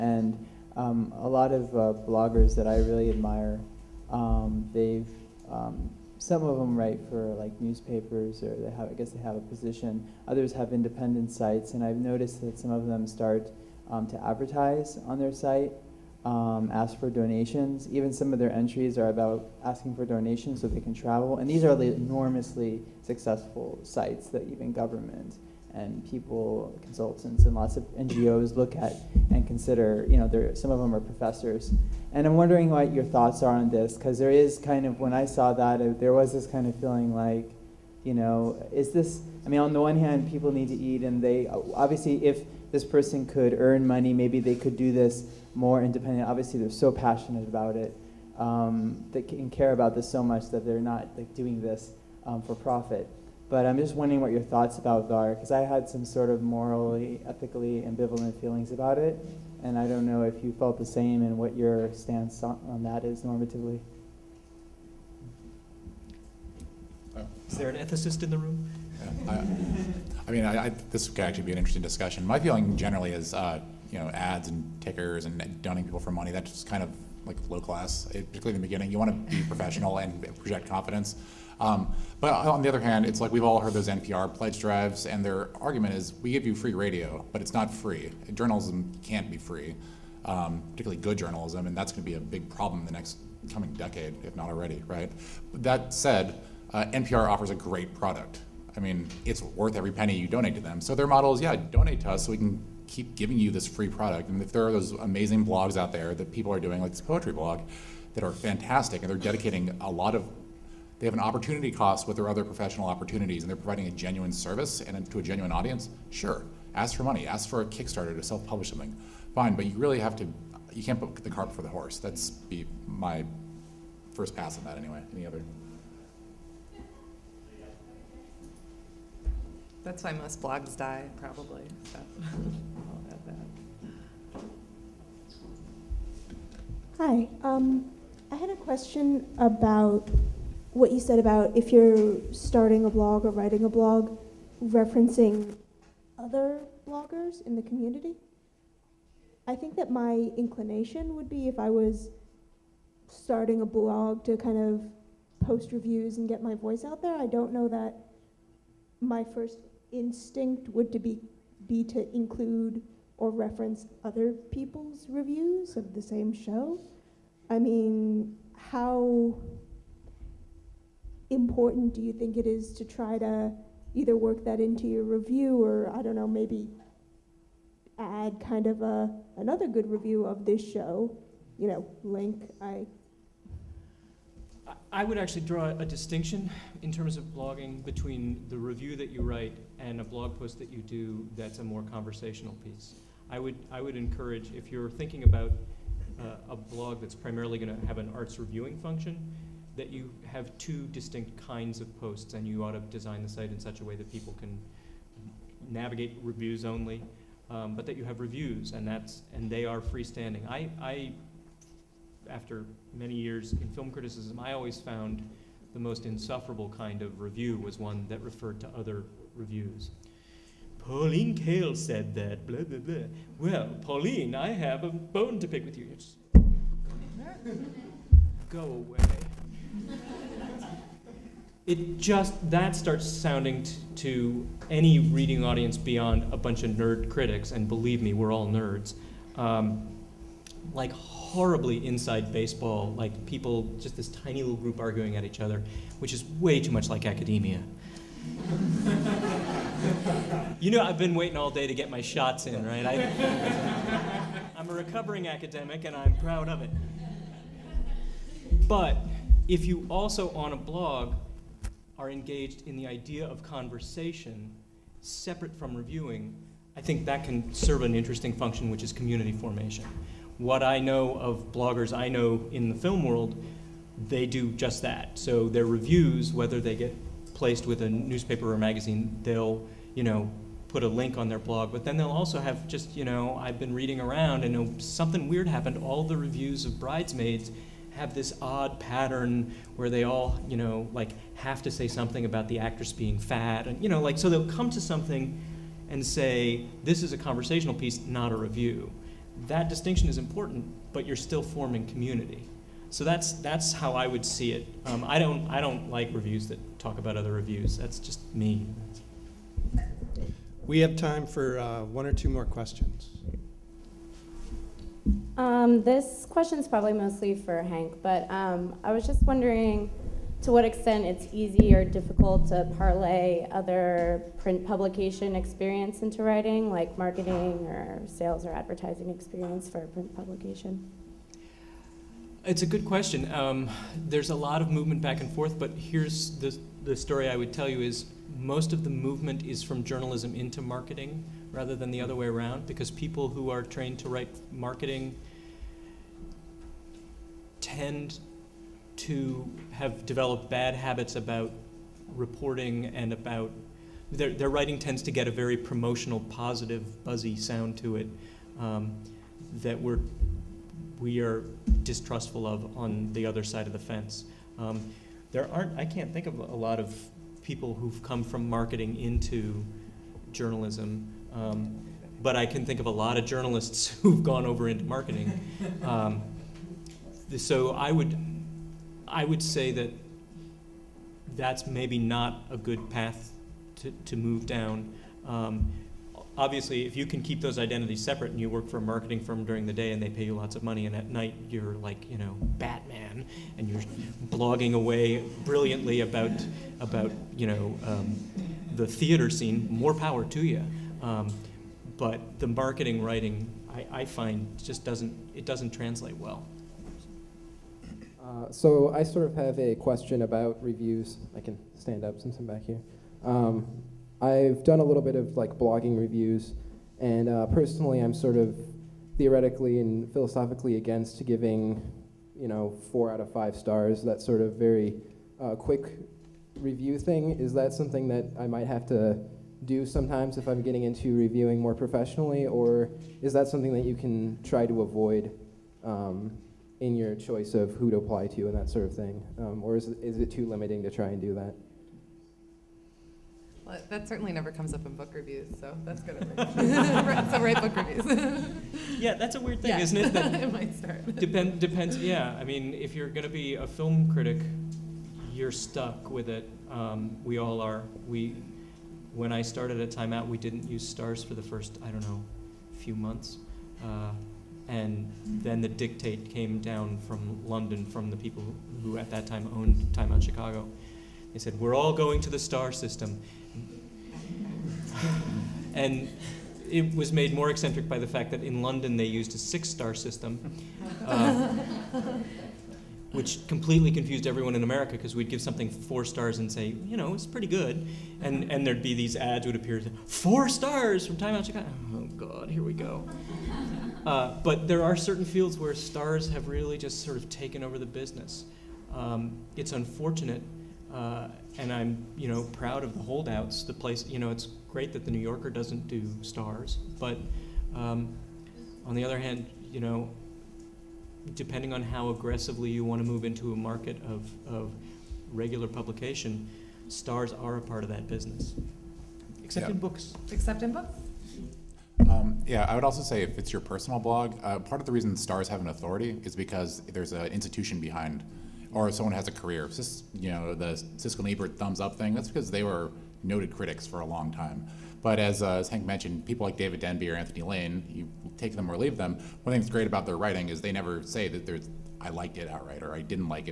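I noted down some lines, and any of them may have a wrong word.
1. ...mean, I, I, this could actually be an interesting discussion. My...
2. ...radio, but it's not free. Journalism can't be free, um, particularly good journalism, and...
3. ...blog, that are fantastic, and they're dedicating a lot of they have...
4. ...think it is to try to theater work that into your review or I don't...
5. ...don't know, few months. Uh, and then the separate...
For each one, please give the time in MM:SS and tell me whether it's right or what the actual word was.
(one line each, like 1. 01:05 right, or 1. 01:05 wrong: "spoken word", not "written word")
1. 01:10 right
2. 01:26 right
3. 01:47 right
4. 02:52 wrong: "either", not "theater"
5. 07:41 wrong: "dictate", not "separate".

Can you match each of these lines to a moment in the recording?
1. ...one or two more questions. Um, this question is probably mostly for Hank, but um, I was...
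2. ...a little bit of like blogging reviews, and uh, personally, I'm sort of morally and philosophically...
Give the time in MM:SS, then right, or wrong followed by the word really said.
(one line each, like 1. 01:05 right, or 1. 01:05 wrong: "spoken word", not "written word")
1. 05:11 right
2. 06:54 wrong: "theoretically", not "morally".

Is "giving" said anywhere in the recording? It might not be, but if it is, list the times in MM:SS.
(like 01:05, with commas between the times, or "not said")
01:43, 07:01.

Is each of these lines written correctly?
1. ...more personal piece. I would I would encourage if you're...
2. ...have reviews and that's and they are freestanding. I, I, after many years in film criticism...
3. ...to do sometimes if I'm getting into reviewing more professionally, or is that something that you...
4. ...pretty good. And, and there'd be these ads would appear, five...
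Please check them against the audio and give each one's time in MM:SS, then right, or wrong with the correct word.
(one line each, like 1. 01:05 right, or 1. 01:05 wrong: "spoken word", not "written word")
1. 03:11 wrong: "conversational", not "personal"
2. 03:28 right
3. 07:08 right
4. 08:07 wrong: "four", not "five".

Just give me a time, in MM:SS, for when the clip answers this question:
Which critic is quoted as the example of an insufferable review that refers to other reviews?
03:40.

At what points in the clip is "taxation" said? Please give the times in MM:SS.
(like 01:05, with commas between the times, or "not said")
not said.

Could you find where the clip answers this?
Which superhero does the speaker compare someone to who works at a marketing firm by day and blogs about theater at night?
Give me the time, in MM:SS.
06:32.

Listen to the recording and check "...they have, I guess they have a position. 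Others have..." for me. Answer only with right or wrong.
right.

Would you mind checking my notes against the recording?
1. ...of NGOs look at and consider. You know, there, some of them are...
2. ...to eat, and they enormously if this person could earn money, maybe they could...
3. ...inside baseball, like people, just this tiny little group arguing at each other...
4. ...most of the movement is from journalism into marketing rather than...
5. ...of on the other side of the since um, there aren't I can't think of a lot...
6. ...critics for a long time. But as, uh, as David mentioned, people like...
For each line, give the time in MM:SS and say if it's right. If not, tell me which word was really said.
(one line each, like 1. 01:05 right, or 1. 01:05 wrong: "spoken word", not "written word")
1. 00:27 right
2. 00:40 wrong: "obviously", not "enormously"
3. 04:01 right
4. 05:38 right
5. 06:02 wrong: "fence", not "since"
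6. 08:53 wrong: "Hank", not "David".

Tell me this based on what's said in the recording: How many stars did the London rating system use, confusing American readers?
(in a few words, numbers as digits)
6.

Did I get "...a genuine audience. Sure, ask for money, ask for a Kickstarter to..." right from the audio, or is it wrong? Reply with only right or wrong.
right.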